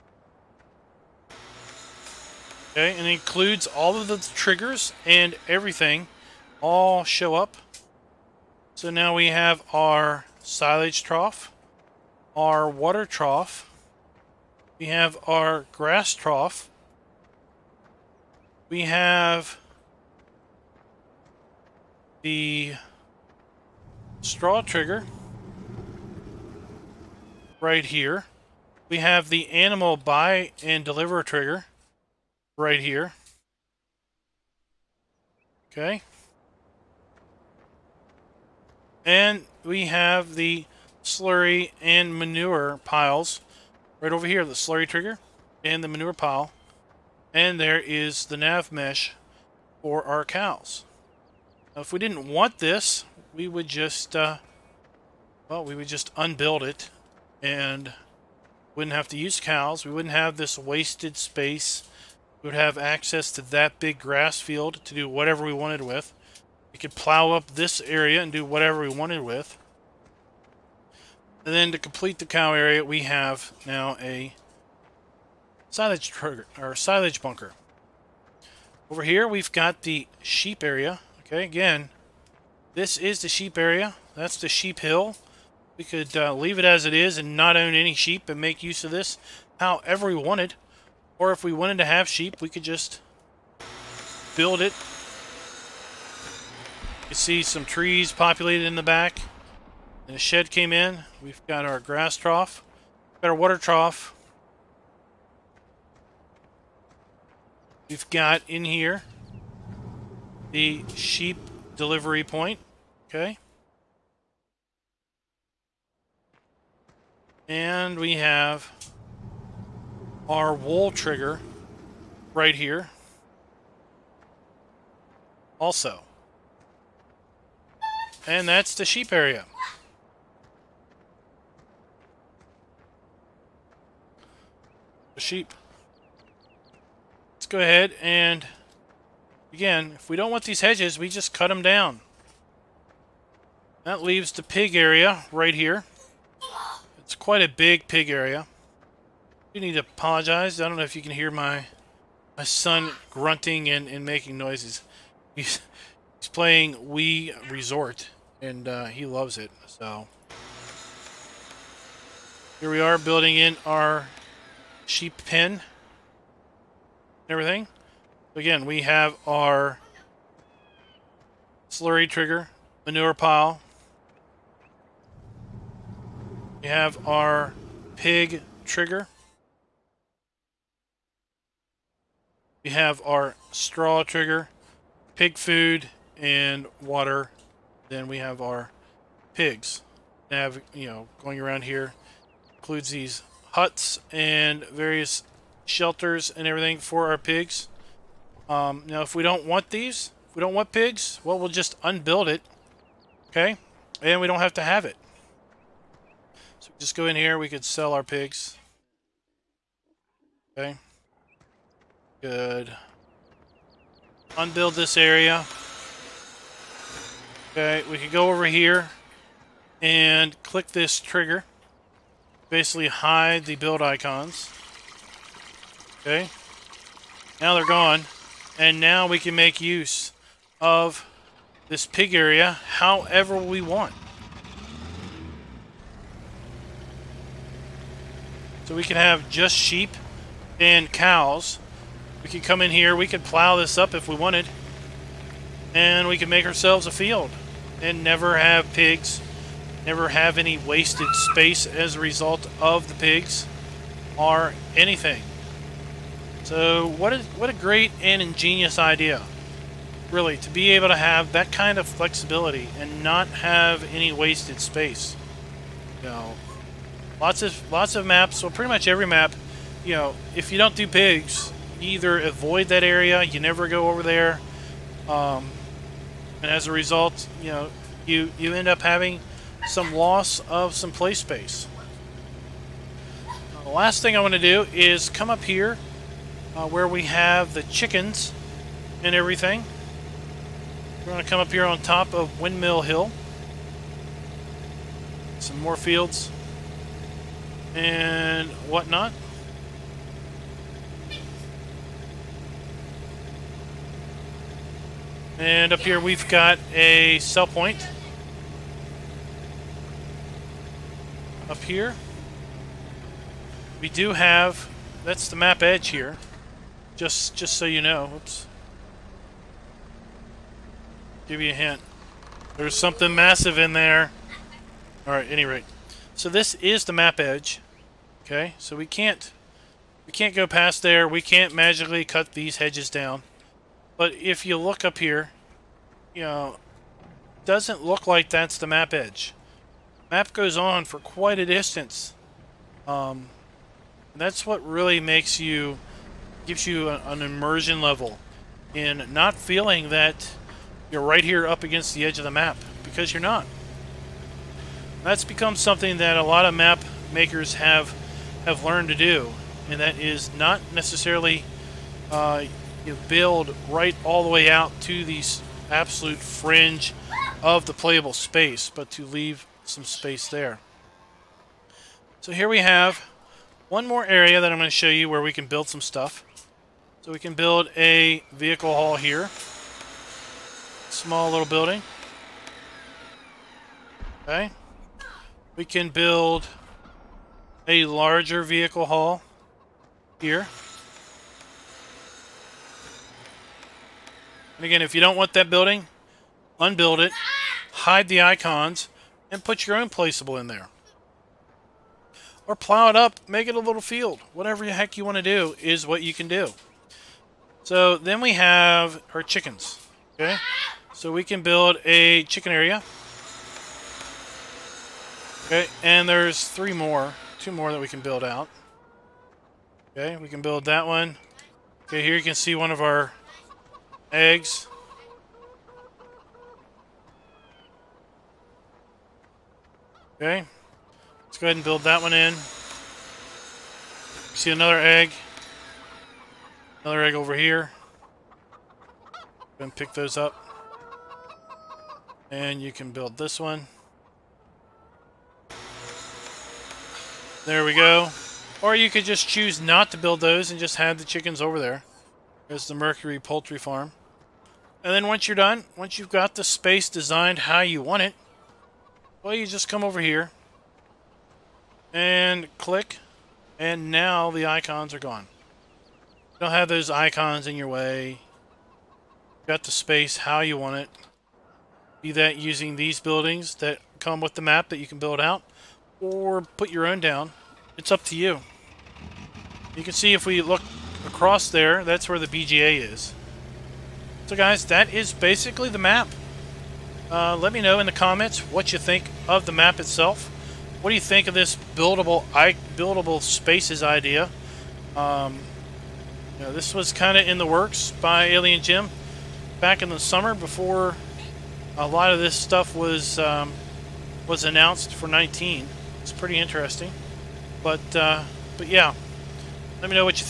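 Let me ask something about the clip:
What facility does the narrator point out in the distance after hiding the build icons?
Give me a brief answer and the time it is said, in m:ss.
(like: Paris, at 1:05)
BGA, at 8:02.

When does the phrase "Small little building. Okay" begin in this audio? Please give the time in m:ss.
6:20.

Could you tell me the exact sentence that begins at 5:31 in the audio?
We can't magically cut these hedges down.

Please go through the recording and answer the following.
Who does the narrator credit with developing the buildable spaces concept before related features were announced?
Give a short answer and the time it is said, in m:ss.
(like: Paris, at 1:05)
Alien Jim, at 8:18.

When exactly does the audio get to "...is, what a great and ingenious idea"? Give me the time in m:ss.
4:17.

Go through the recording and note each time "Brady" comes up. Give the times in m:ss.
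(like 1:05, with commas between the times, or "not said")
not said.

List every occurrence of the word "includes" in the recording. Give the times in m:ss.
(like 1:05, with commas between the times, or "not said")
0:03, 3:12.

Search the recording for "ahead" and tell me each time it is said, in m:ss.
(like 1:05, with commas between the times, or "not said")
2:17, 7:11.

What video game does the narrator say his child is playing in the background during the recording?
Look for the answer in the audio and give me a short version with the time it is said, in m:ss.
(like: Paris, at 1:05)
Wii Resort, at 2:36.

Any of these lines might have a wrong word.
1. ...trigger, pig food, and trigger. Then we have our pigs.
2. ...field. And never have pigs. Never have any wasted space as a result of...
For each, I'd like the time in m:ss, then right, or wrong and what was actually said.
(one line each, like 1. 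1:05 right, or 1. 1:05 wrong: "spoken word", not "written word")
1. 3:04 wrong: "water", not "trigger"
2. 4:06 right.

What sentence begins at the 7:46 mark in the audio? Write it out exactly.
You don't have those icons in your way.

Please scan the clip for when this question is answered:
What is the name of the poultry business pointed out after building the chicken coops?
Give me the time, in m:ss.
7:32.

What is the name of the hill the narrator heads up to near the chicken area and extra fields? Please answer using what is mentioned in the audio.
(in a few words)
Windmill Hill.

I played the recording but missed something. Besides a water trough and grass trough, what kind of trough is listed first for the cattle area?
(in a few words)
Silage trough.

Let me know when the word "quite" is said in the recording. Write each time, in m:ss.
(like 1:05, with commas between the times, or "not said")
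2:27, 5:40.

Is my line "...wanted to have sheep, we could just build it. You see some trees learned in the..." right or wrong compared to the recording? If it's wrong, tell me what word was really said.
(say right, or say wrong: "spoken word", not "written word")
wrong: "populated", not "learned".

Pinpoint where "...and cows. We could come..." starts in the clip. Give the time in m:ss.
4:00.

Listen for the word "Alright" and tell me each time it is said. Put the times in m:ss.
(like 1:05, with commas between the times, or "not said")
5:25.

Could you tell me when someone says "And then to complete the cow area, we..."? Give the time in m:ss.
1:11.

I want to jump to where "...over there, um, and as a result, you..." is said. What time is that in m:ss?
4:33.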